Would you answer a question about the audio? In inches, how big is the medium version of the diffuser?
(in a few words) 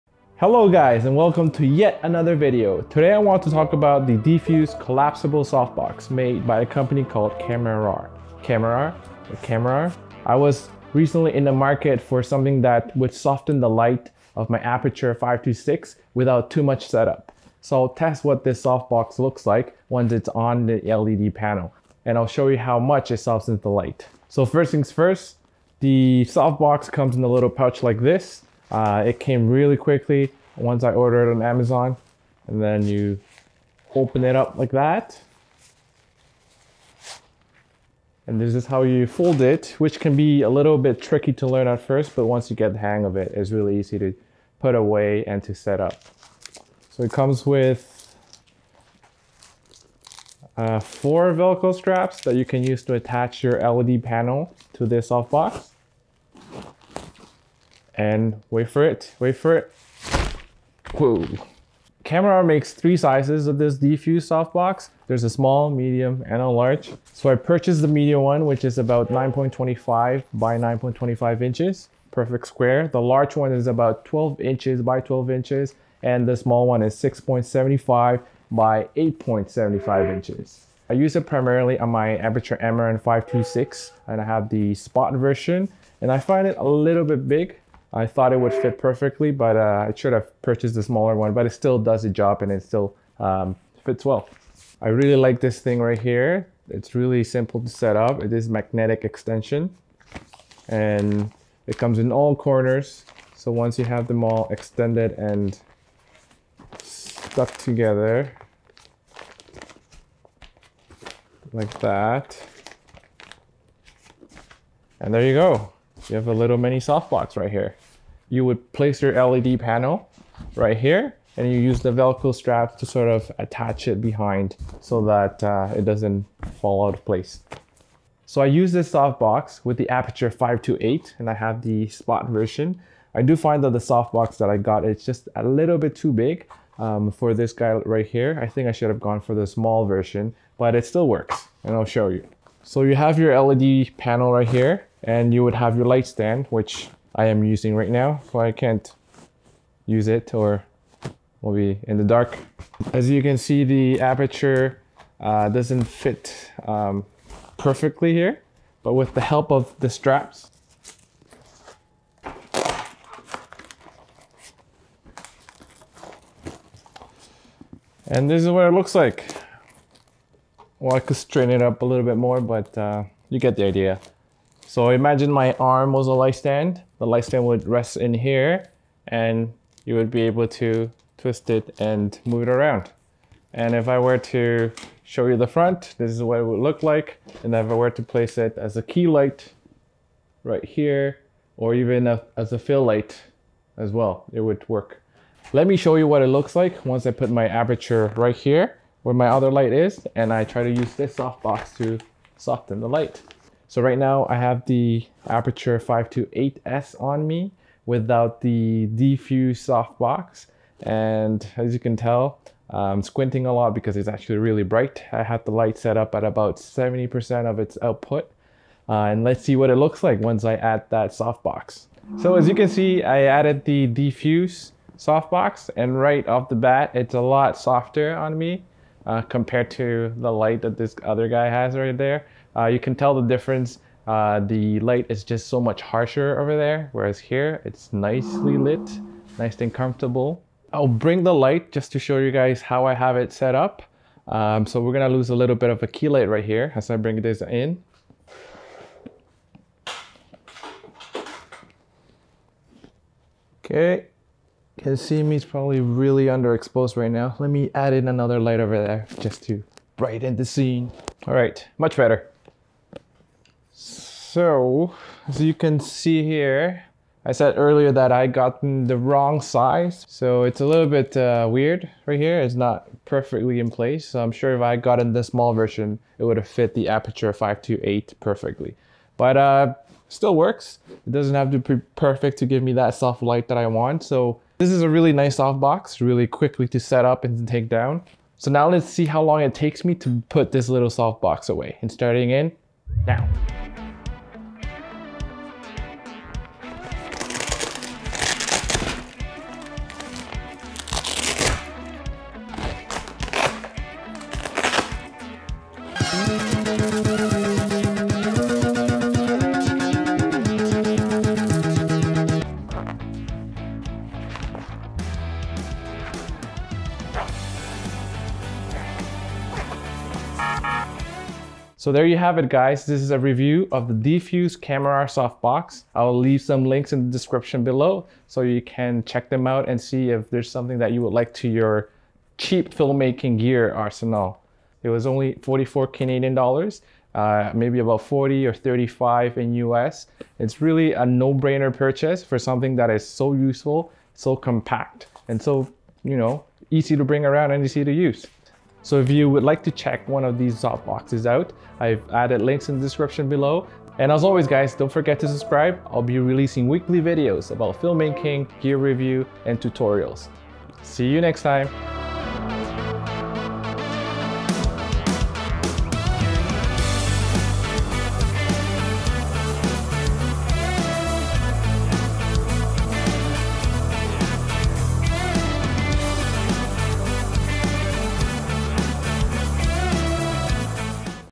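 9.25 by 9.25 inches.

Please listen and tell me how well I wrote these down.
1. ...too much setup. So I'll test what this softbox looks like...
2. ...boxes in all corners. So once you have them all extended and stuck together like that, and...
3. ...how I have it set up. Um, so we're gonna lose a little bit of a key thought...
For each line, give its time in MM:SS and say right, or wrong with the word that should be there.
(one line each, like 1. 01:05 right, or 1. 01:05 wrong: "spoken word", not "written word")
1. 00:16 right
2. 01:41 wrong: "comes", not "boxes"
3. 04:02 wrong: "light", not "thought".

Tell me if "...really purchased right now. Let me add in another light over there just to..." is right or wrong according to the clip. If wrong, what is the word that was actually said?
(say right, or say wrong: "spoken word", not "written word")
wrong: "underexposed", not "purchased".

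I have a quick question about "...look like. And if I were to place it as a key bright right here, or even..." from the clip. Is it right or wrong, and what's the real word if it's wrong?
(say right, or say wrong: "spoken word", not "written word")
wrong: "light", not "bright".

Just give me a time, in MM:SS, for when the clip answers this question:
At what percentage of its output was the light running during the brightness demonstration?
03:36.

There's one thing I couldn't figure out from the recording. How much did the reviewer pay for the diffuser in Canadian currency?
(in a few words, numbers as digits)
44 Canadian dollars.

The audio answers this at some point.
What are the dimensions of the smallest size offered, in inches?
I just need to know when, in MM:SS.
01:16.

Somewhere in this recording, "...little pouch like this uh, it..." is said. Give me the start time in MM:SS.
00:27.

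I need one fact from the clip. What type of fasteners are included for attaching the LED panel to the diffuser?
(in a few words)
Velcro straps.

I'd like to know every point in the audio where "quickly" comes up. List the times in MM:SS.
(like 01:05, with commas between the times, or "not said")
00:29, 04:46.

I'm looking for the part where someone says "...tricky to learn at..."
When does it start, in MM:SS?
00:41.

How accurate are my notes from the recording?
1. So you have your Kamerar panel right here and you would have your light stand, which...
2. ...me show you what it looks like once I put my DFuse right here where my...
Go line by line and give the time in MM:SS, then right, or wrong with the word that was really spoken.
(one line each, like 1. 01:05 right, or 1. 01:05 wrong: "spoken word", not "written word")
1. 02:22 wrong: "LED", not "Kamerar"
2. 03:15 wrong: "Aputure", not "DFuse".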